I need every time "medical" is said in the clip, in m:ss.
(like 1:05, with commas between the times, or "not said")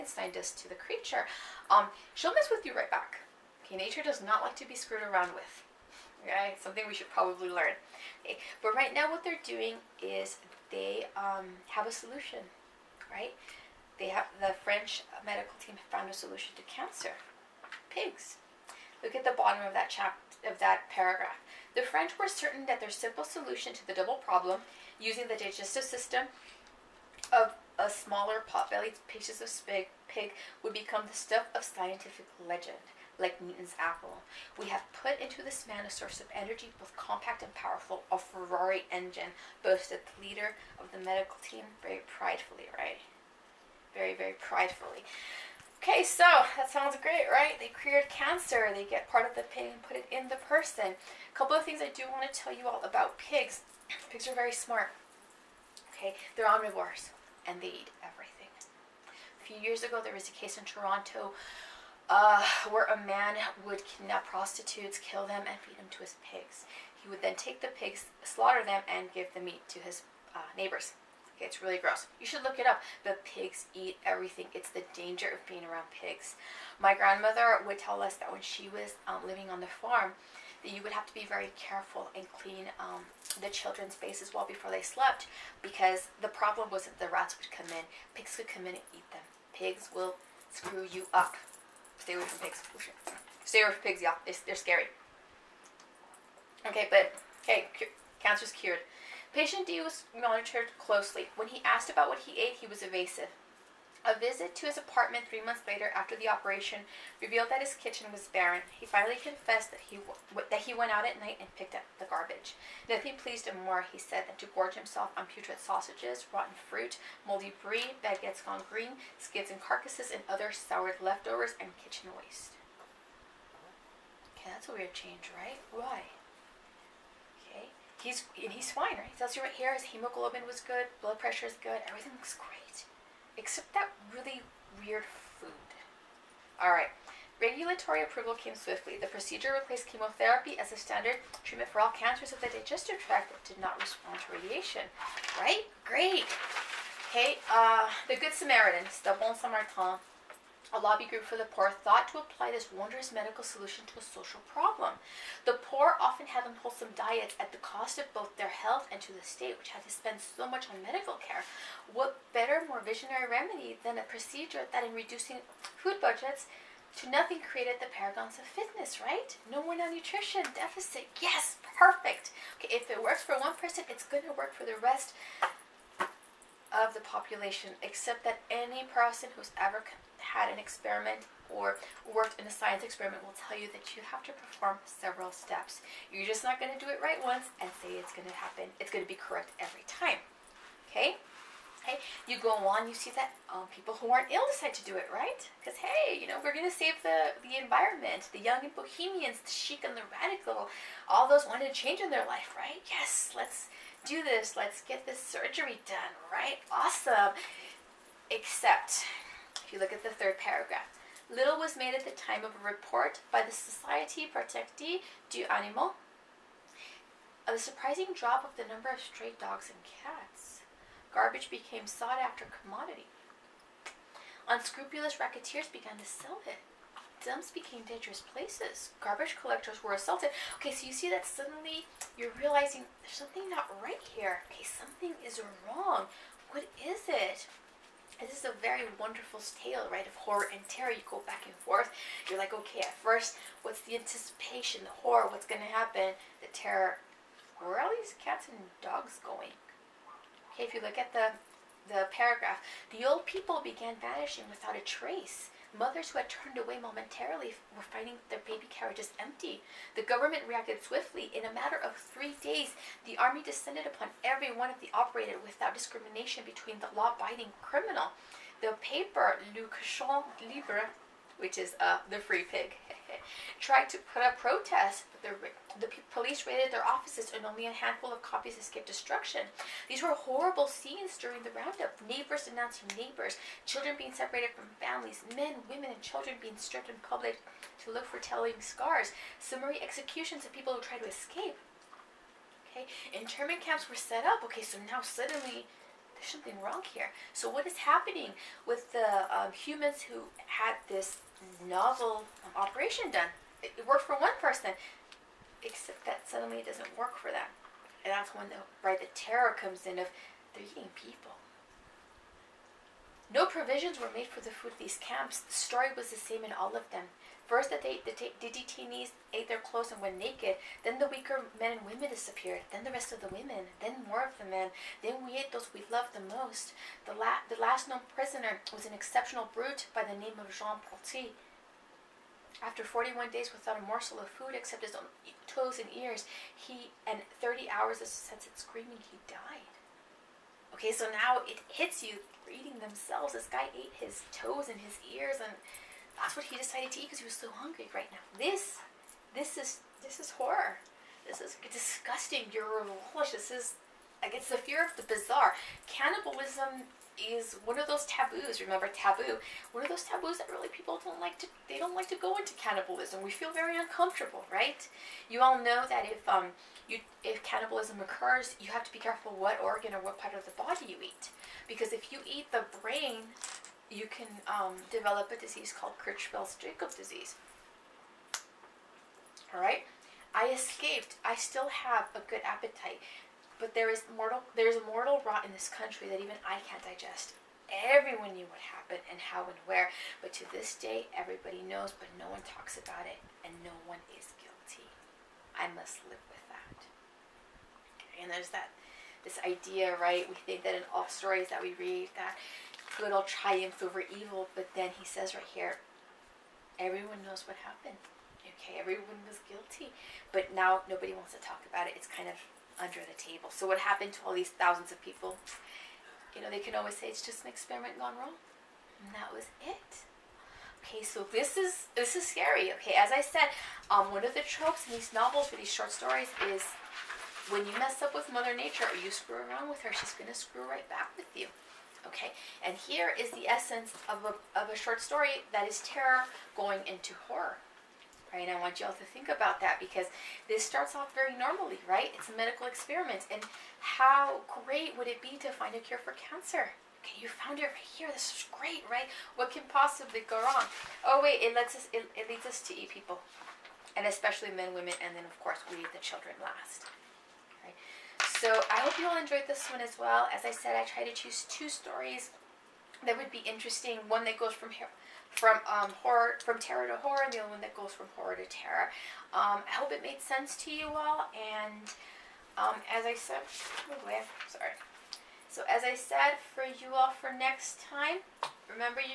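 0:15, 0:41, 2:33, 2:40, 7:22.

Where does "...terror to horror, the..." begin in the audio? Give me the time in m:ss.
7:46.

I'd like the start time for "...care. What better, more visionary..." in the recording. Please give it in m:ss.
2:41.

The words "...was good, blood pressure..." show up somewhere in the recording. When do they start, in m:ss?
2:10.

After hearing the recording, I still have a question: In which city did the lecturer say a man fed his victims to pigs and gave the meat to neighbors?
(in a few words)
Toronto.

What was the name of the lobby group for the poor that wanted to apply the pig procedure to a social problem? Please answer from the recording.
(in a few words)
The Good Samaritans.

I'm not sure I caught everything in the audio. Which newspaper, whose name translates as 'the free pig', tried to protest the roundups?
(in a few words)
Le Cochon Libre.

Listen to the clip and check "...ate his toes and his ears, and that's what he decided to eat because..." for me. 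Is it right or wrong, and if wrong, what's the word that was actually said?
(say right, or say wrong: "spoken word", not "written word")
right.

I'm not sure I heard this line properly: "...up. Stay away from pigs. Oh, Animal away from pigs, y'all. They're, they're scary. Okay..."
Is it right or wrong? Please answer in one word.
wrong.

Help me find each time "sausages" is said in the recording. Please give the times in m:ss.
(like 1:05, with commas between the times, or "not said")
1:55.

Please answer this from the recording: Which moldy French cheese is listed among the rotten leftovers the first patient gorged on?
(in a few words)
brie.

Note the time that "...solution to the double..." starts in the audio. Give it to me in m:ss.
0:23.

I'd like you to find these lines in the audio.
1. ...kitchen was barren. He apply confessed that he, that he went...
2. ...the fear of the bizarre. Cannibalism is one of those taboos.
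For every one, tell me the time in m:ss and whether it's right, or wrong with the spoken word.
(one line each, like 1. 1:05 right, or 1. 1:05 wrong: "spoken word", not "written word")
1. 1:47 wrong: "finally", not "apply"
2. 5:54 right.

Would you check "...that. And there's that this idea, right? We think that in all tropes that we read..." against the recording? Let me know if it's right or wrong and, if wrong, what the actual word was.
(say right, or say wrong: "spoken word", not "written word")
wrong: "stories", not "tropes".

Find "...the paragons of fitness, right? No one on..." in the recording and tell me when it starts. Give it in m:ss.
2:47.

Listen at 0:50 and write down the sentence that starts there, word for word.
A couple of things I do want to tell you all about pigs.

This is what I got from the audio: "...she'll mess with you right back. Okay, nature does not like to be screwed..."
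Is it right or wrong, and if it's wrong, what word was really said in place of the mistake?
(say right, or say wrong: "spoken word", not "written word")
right.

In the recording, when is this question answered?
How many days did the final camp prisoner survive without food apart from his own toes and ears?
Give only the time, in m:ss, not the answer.
5:32.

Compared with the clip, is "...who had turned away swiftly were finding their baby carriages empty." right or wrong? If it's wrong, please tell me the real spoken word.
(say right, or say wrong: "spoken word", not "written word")
wrong: "momentarily", not "swiftly".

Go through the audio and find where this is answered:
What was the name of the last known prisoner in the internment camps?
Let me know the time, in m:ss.
5:30.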